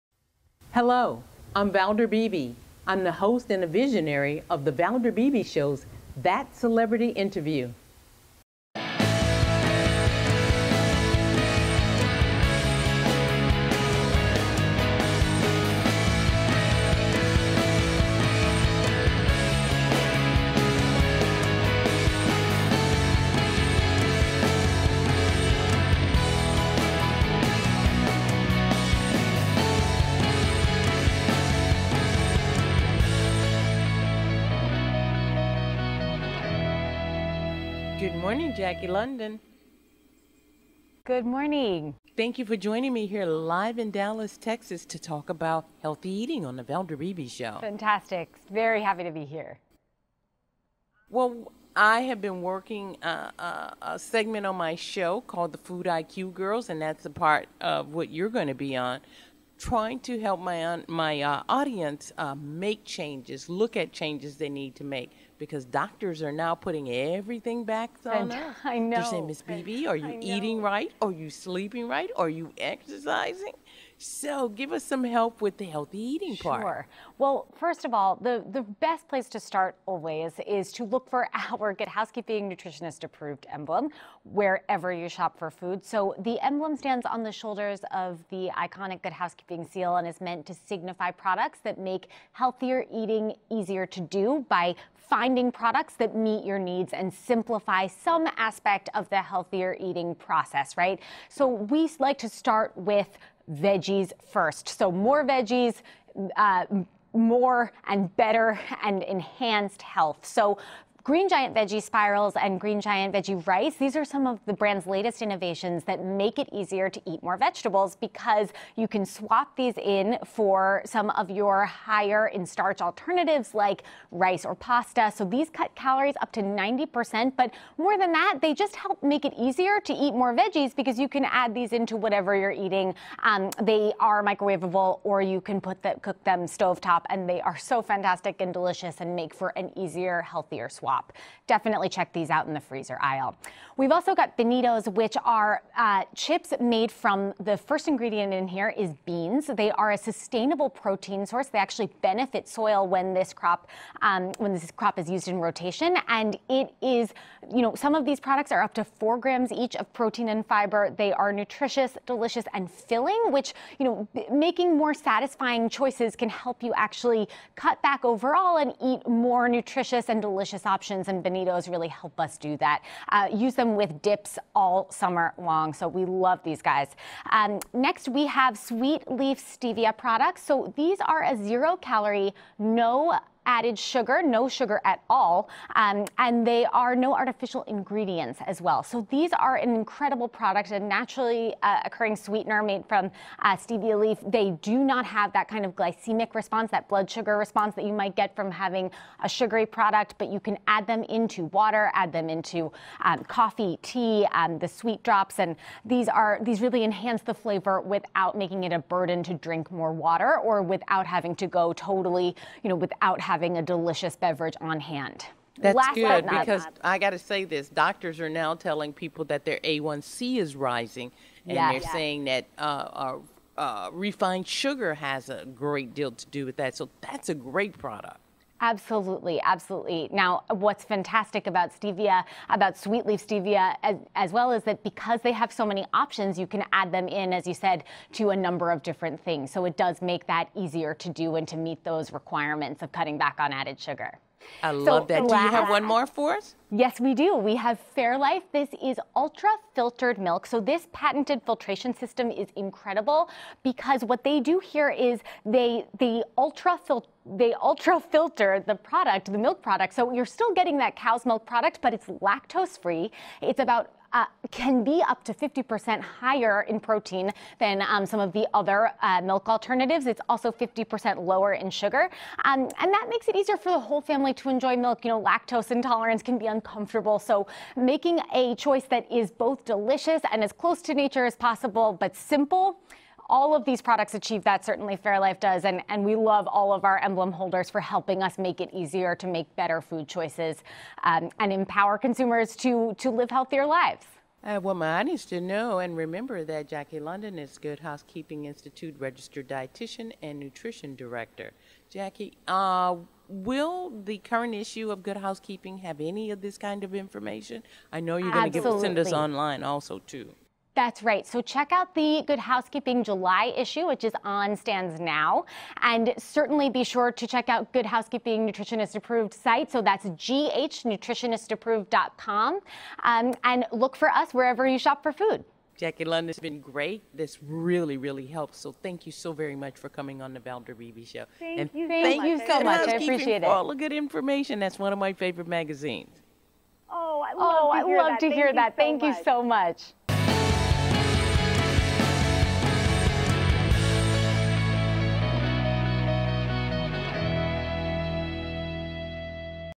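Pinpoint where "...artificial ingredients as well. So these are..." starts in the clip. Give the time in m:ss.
3:07.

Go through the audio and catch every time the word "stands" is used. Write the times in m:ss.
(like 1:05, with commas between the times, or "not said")
1:26, 5:14.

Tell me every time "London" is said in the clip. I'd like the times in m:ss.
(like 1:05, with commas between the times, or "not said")
0:38, 4:56, 5:26.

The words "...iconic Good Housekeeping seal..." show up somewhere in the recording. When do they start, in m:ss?
1:28.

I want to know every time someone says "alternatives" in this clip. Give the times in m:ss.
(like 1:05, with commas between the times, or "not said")
2:02, 4:29.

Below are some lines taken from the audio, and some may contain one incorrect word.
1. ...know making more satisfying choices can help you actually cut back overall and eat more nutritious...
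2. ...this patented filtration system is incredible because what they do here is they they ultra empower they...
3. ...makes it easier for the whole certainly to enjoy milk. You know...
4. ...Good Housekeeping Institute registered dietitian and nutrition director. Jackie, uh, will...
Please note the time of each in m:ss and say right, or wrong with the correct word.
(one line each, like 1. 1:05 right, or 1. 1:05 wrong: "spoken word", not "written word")
1. 2:43 right
2. 4:10 wrong: "filter", not "empower"
3. 4:33 wrong: "family", not "certainly"
4. 4:57 right.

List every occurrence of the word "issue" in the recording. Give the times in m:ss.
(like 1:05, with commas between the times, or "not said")
5:04, 5:13.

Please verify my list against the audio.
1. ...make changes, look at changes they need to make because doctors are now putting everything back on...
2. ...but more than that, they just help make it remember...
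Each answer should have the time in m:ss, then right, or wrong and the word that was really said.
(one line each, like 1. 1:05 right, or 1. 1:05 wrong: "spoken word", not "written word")
1. 1:02 right
2. 2:07 wrong: "easier", not "remember".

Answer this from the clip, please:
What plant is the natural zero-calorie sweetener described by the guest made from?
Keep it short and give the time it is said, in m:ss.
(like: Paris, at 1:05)
stevia leaf, at 3:13.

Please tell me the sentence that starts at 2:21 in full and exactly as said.
Definitely check these out in the freezer aisle.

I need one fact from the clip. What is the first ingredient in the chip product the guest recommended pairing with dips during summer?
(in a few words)
beans.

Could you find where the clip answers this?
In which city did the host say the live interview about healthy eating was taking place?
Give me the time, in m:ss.
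0:43.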